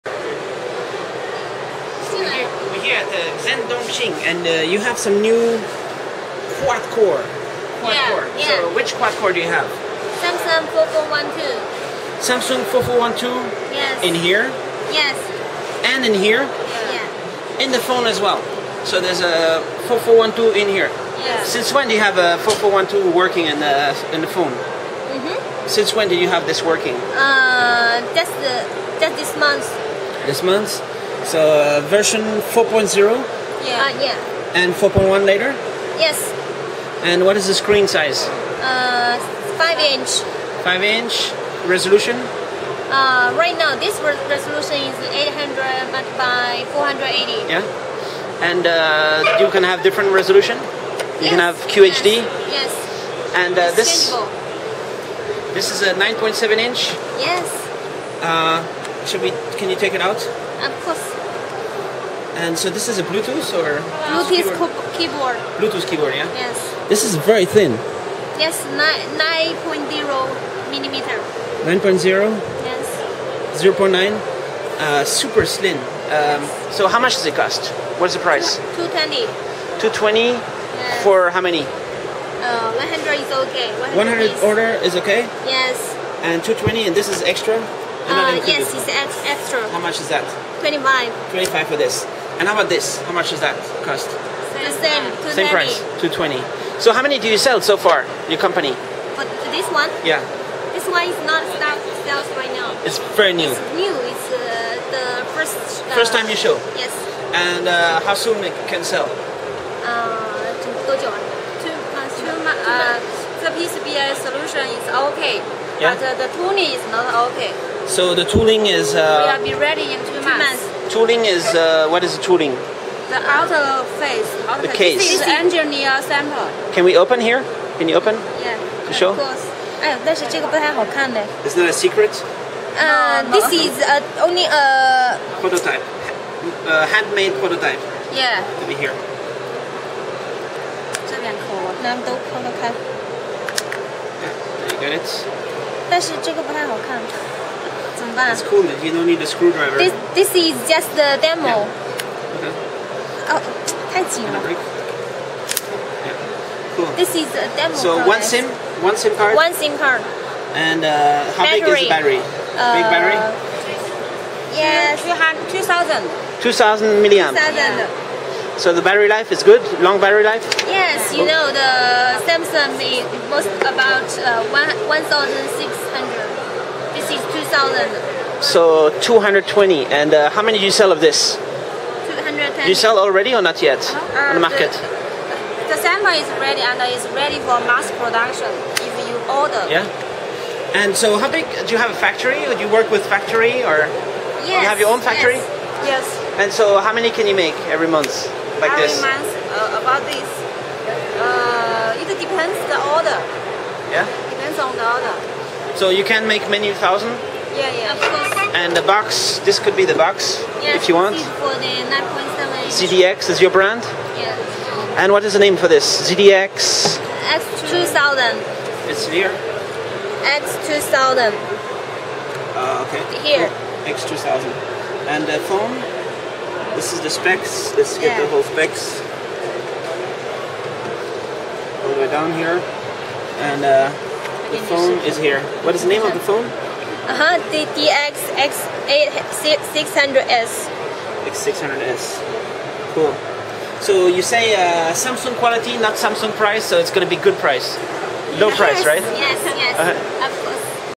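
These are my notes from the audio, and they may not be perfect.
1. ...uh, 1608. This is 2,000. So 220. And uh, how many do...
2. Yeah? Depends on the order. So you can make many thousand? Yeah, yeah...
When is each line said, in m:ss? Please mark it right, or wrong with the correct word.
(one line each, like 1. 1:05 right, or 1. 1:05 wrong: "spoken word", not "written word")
1. 2:54 wrong: "1600", not "1608"
2. 3:23 right.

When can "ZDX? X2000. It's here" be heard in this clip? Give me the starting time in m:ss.
3:36.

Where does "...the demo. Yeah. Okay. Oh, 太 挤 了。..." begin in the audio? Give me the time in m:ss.
2:30.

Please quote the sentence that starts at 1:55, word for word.
but uh, the tooling is not okay.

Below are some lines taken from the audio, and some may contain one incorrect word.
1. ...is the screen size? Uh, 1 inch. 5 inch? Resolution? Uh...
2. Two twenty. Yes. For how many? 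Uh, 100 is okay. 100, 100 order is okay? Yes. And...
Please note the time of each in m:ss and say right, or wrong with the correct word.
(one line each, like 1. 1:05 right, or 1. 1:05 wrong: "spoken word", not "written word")
1. 0:37 wrong: "5", not "1"
2. 1:19 right.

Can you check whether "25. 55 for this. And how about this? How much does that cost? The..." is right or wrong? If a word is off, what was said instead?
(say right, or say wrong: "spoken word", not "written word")
wrong: "25", not "55".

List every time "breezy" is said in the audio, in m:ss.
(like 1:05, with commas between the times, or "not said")
not said.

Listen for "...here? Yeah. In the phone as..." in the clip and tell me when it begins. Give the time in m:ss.
0:16.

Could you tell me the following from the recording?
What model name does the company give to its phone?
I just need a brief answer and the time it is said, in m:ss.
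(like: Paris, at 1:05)
X600S, at 4:01.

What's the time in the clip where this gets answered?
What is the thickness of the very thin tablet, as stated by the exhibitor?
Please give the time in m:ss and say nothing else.
1:08.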